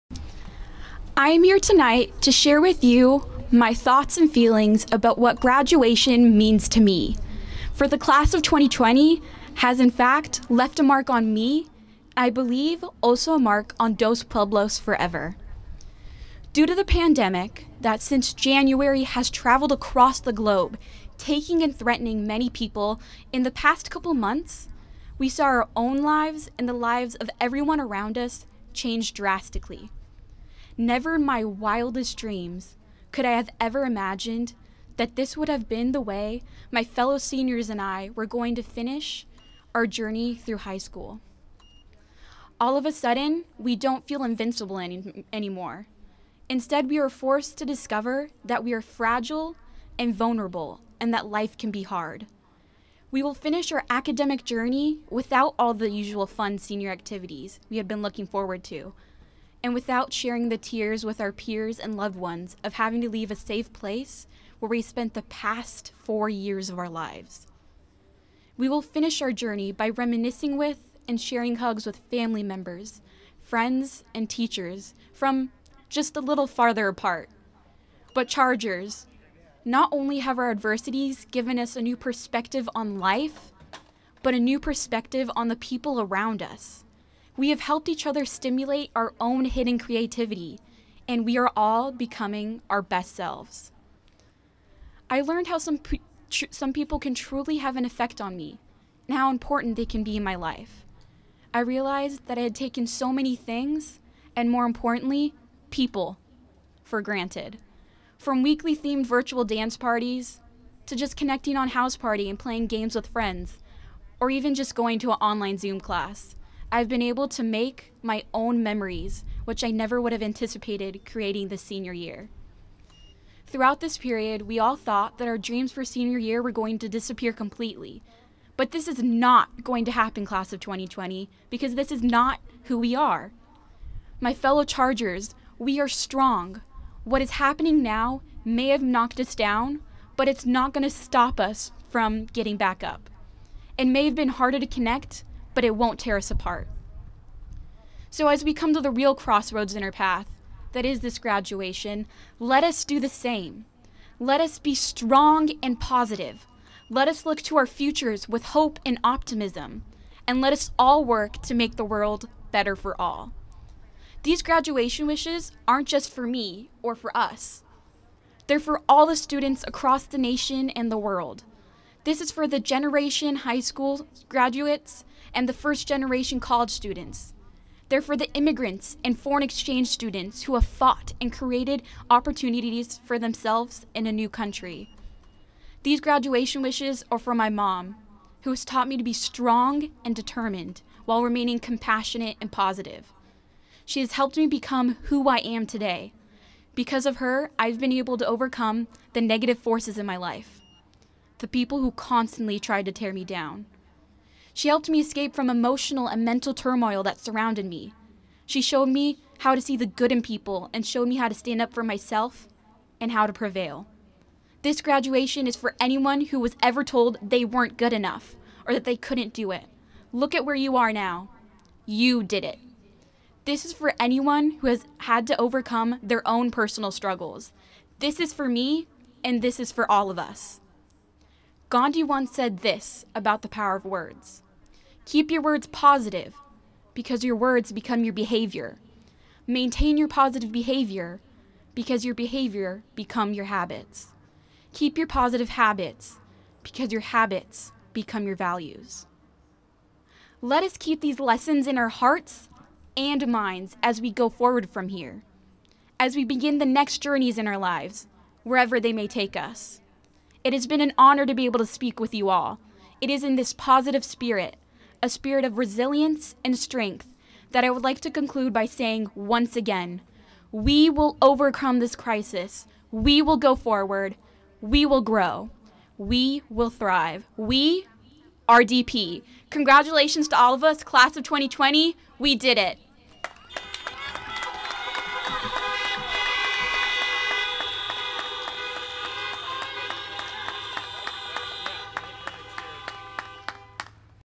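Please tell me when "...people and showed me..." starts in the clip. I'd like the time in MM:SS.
03:30.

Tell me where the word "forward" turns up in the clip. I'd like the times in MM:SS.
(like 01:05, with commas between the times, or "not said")
00:58, 04:14, 04:33.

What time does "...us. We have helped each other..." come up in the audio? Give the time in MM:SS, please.
01:26.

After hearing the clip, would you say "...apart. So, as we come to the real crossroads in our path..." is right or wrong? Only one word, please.
right.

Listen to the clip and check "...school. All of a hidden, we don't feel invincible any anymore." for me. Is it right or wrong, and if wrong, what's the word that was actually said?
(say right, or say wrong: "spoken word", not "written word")
wrong: "sudden", not "hidden".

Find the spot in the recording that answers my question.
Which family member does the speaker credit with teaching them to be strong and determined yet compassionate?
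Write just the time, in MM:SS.
03:07.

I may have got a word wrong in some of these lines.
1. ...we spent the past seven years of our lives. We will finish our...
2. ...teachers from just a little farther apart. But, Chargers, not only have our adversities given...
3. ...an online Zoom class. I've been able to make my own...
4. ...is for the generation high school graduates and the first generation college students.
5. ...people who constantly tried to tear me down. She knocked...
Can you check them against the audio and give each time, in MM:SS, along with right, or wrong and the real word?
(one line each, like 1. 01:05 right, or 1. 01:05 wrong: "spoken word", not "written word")
1. 01:04 wrong: "four", not "seven"
2. 01:14 right
3. 01:55 right
4. 02:52 right
5. 03:21 wrong: "helped", not "knocked".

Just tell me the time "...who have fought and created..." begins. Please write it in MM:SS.
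03:00.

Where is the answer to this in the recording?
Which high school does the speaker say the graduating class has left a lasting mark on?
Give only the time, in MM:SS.
00:13.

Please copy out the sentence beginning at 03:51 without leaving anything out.
Gandhi once said this about the power of words Keep your words positive, because your words become your behavior.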